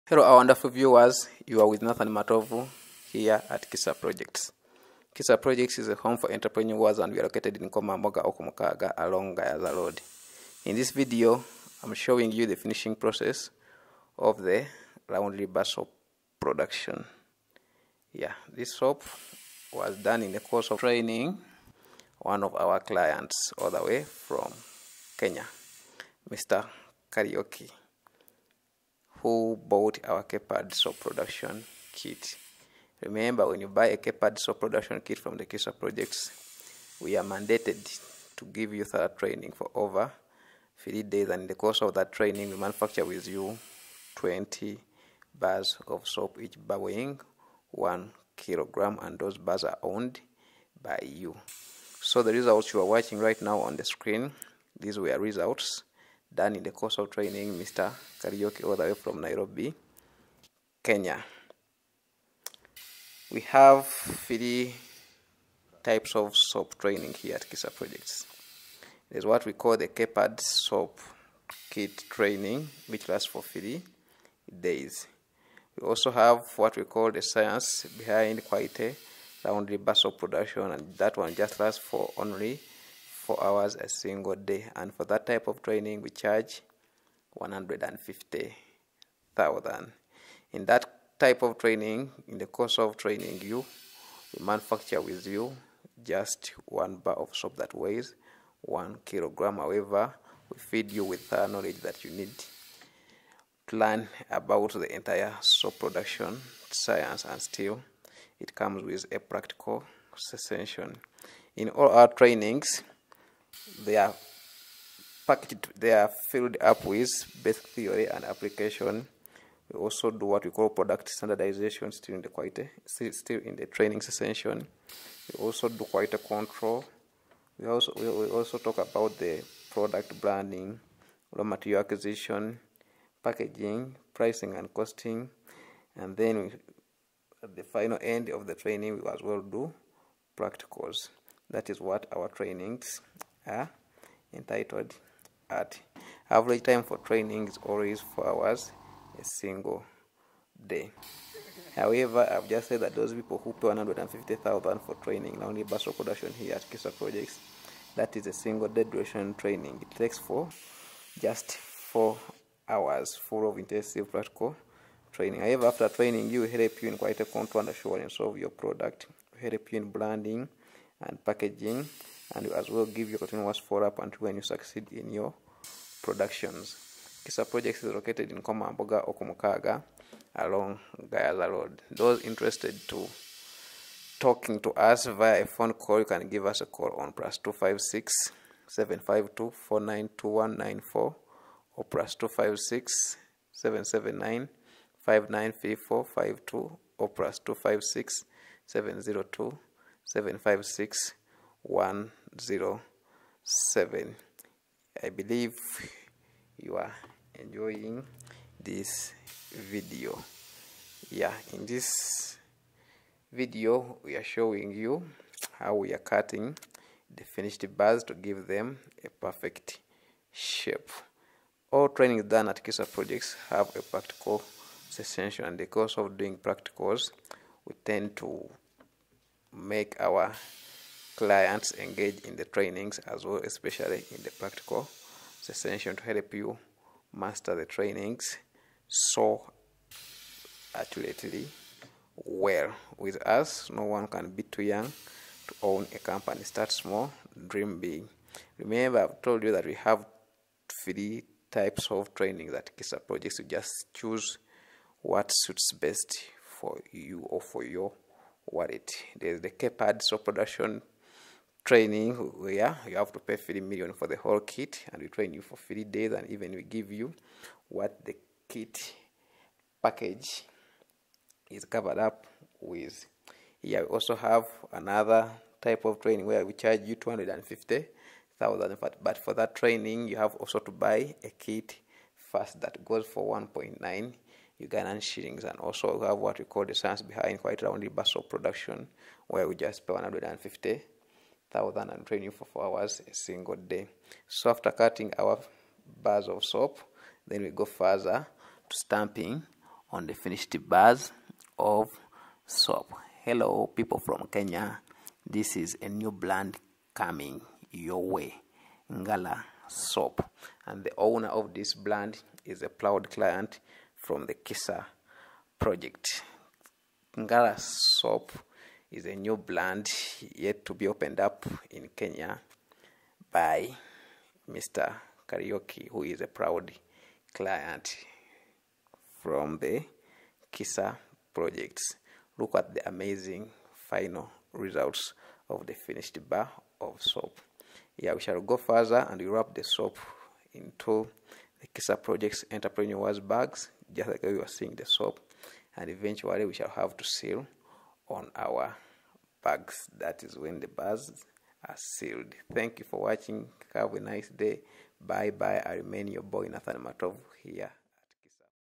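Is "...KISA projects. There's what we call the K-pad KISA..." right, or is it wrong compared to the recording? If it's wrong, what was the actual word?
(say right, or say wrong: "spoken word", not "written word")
wrong: "SOAP", not "KISA".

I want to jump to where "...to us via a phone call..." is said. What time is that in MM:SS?
03:04.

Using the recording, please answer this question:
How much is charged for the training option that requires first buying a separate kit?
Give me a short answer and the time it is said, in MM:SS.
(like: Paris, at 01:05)
250,000, at 04:36.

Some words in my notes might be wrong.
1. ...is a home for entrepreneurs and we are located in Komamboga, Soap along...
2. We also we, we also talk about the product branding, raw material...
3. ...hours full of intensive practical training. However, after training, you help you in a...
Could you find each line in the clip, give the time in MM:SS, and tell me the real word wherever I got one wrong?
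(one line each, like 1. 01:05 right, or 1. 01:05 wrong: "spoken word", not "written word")
1. 00:05 wrong: "Okumukaga", not "Soap"
2. 02:07 right
3. 02:42 right.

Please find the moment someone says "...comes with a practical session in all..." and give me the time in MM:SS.
01:48.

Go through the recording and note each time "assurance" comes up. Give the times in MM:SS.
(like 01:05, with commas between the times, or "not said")
02:47.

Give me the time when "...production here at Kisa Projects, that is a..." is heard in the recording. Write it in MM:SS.
02:35.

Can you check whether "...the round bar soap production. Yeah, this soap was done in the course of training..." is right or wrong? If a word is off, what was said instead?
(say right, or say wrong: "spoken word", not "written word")
right.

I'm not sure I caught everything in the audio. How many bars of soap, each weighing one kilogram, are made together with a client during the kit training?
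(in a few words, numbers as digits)
20.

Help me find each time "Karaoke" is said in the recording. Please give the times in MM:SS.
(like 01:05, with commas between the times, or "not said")
00:27, 05:25.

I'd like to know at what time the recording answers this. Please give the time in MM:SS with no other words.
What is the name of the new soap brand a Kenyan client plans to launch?
05:08.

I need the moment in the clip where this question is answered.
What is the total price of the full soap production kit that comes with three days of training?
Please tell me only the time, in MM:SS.
04:23.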